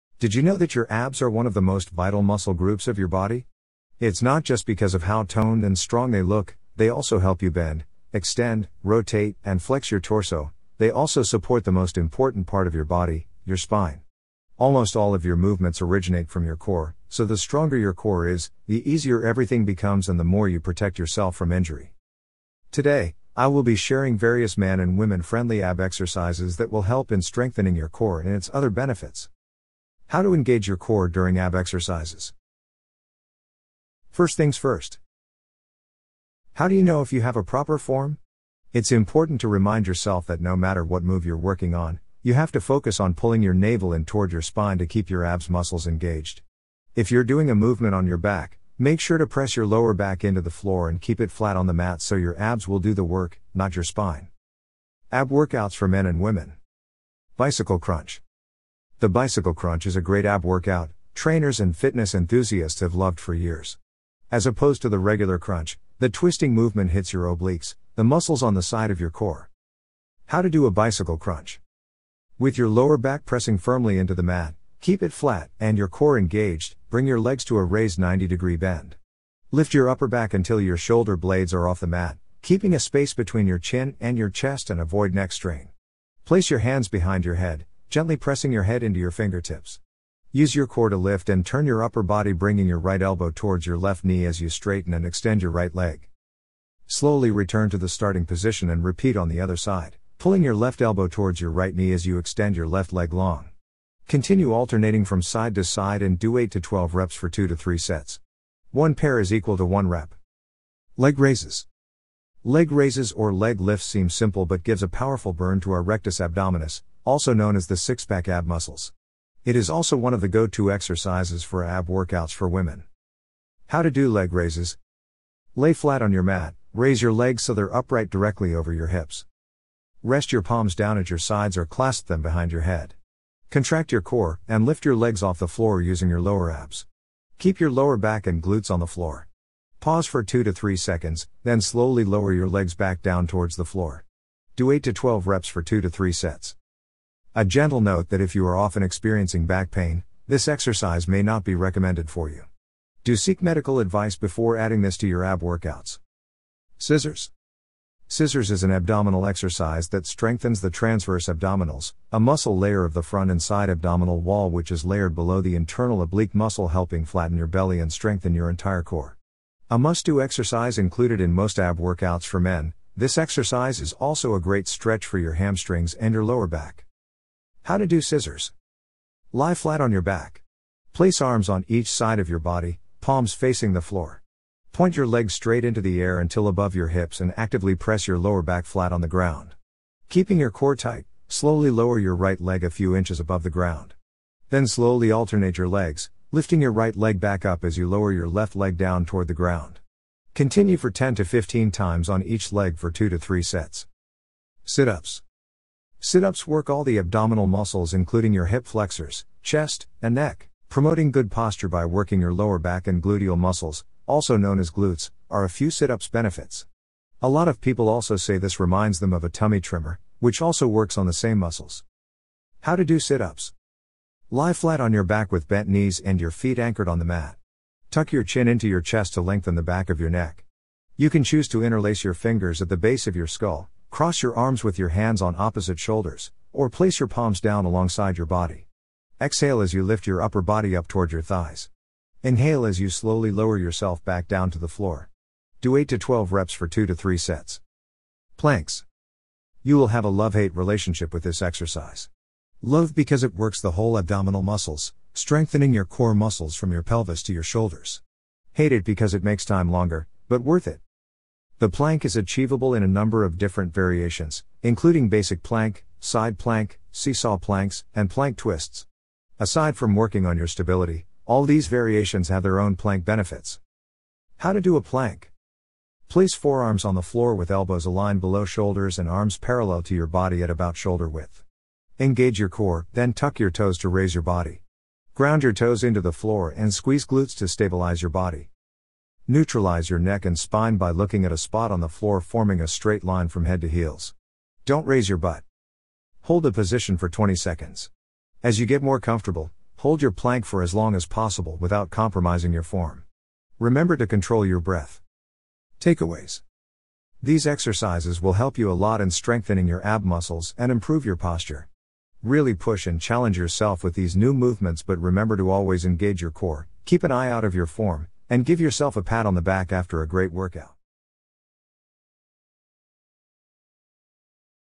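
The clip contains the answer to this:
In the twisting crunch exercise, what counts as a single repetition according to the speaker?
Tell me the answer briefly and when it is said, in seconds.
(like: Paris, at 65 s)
One pair, at 108 s.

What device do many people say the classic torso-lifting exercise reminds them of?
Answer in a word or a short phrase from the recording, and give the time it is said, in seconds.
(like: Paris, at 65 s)
Tummy trimmer, at 219 s.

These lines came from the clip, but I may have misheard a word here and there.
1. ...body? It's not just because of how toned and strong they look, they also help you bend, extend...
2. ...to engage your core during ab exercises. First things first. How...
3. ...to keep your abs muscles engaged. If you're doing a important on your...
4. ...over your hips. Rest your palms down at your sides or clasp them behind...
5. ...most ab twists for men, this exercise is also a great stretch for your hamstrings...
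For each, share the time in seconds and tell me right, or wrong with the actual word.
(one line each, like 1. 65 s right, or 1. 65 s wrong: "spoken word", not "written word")
1. 3 s right
2. 30 s right
3. 44 s wrong: "movement", not "important"
4. 128 s right
5. 171 s wrong: "workouts", not "twists".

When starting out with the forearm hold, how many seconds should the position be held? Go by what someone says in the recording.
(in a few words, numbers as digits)
20 seconds.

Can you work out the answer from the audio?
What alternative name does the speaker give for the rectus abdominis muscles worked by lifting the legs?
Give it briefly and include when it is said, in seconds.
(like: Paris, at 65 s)
Six pack ab muscles, at 117 s.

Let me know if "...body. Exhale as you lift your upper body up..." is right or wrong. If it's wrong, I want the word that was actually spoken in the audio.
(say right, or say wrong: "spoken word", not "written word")
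right.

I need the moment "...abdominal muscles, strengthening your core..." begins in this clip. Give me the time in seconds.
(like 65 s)
253 s.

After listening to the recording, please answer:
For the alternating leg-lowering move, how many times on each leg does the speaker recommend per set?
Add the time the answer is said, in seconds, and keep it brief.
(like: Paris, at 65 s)
10 to 15, at 200 s.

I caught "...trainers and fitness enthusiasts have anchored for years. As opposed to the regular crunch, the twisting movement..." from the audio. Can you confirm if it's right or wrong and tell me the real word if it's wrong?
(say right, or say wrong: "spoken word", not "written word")
wrong: "loved", not "anchored".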